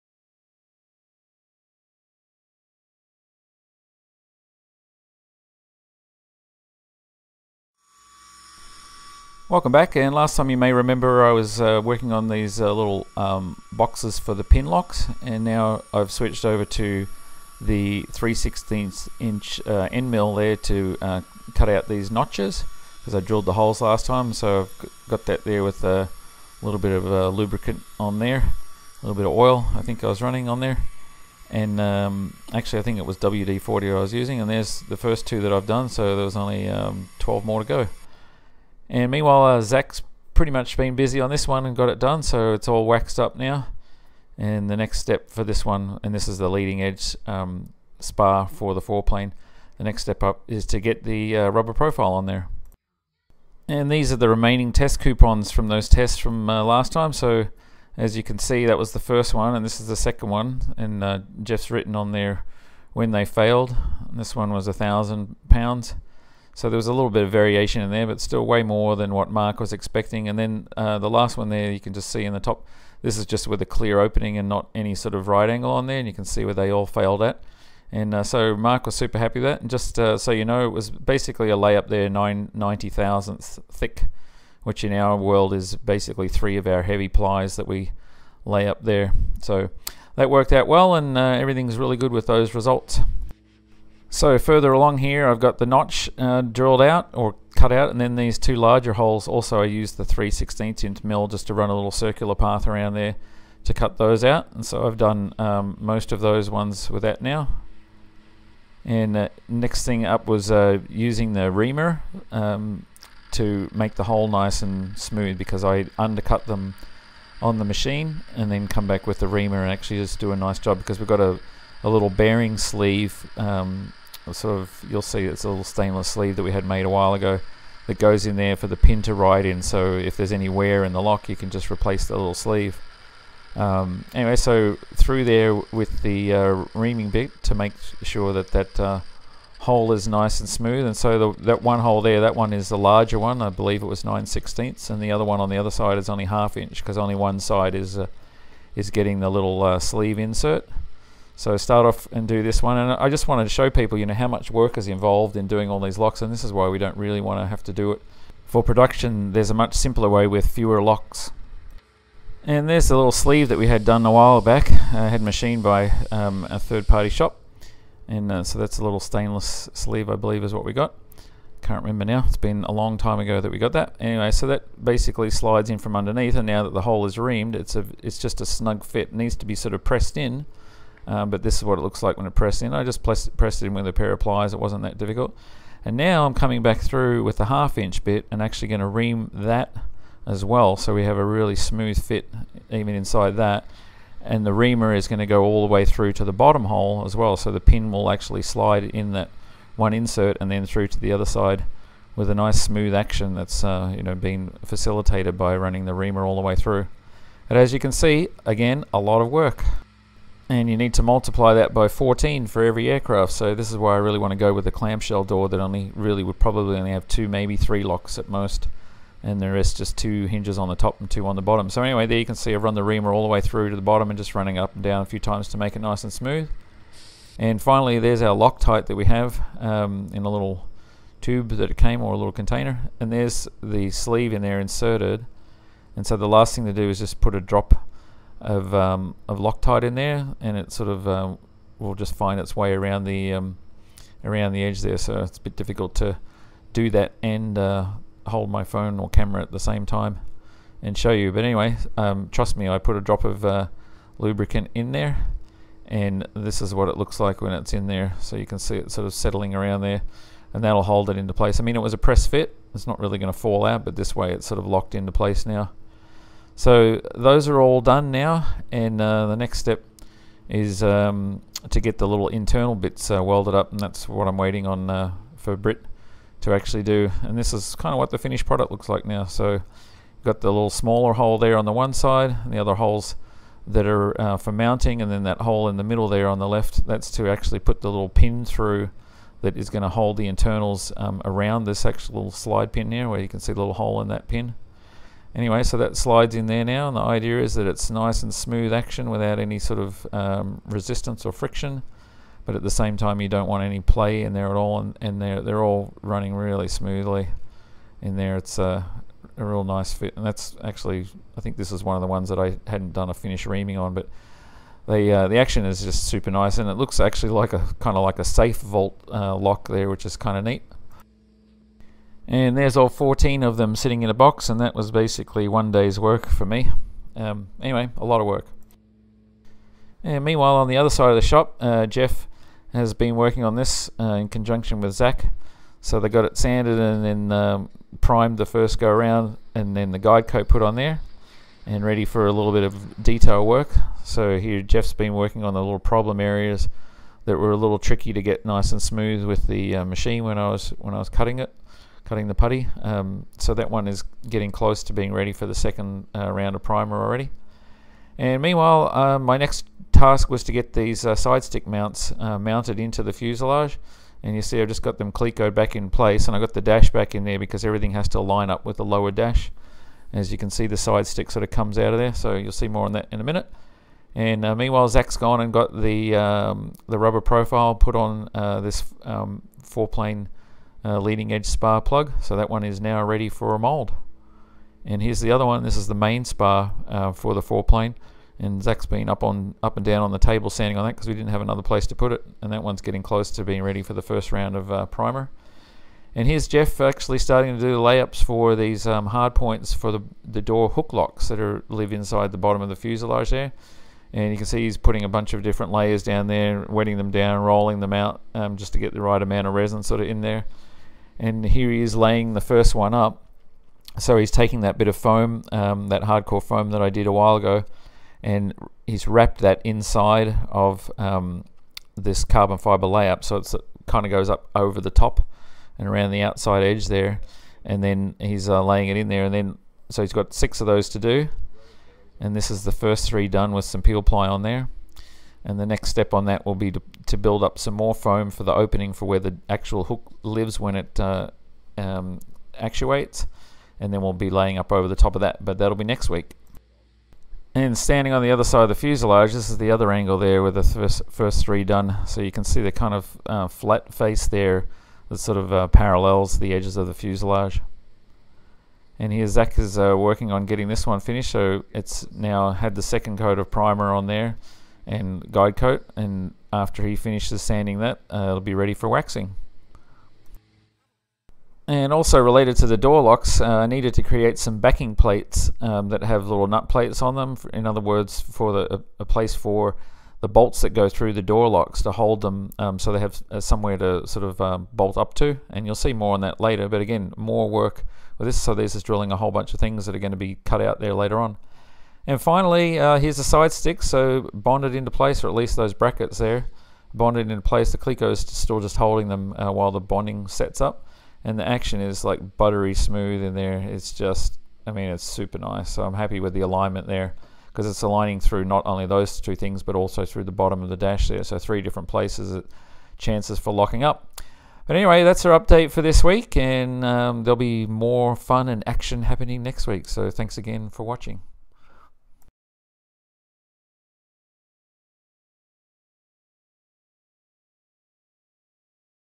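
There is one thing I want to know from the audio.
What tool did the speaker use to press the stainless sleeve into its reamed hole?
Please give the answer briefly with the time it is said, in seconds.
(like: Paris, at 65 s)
pliers, at 183 s.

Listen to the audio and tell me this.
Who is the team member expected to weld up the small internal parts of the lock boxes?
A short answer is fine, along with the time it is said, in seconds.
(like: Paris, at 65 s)
Brit, at 275 s.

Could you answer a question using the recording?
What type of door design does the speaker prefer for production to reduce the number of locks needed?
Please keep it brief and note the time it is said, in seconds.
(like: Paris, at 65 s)
clamshell door, at 214 s.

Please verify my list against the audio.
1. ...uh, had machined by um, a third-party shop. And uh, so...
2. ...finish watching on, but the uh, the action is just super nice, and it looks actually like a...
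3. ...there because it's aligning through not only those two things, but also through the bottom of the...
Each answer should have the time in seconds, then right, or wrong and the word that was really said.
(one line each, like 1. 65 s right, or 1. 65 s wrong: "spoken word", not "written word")
1. 165 s right
2. 313 s wrong: "reaming", not "watching"
3. 506 s right.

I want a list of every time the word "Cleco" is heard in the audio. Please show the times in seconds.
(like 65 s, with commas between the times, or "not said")
365 s, 497 s.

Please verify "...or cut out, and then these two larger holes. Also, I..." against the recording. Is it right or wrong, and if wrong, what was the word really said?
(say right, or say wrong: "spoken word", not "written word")
right.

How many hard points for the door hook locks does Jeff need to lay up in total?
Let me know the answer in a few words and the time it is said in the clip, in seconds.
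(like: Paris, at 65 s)
6, at 430 s.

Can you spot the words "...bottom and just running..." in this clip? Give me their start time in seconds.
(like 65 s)
223 s.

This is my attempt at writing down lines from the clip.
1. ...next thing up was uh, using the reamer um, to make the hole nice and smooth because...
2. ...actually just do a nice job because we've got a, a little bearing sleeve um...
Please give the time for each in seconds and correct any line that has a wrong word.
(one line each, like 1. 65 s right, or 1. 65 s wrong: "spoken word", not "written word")
1. 109 s right
2. 119 s right.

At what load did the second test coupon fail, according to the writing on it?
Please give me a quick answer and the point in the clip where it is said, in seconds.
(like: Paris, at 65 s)
1000 pounds, at 64 s.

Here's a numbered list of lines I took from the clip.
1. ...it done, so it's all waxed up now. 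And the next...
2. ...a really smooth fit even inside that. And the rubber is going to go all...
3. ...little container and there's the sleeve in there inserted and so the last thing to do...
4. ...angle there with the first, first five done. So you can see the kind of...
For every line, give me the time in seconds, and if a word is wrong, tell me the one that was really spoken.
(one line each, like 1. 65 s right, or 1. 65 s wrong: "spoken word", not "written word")
1. 41 s right
2. 191 s wrong: "reamer", not "rubber"
3. 232 s right
4. 449 s wrong: "three", not "five".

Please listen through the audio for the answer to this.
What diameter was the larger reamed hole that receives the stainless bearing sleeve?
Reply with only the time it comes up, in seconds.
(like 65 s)
144 s.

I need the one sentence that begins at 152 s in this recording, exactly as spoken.
And I just wanted to show people, you know, how much work is involved in doing all these locks.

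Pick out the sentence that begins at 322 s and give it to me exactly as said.
And there's all 14 of them sitting in a box, and that was basically one day's work for me.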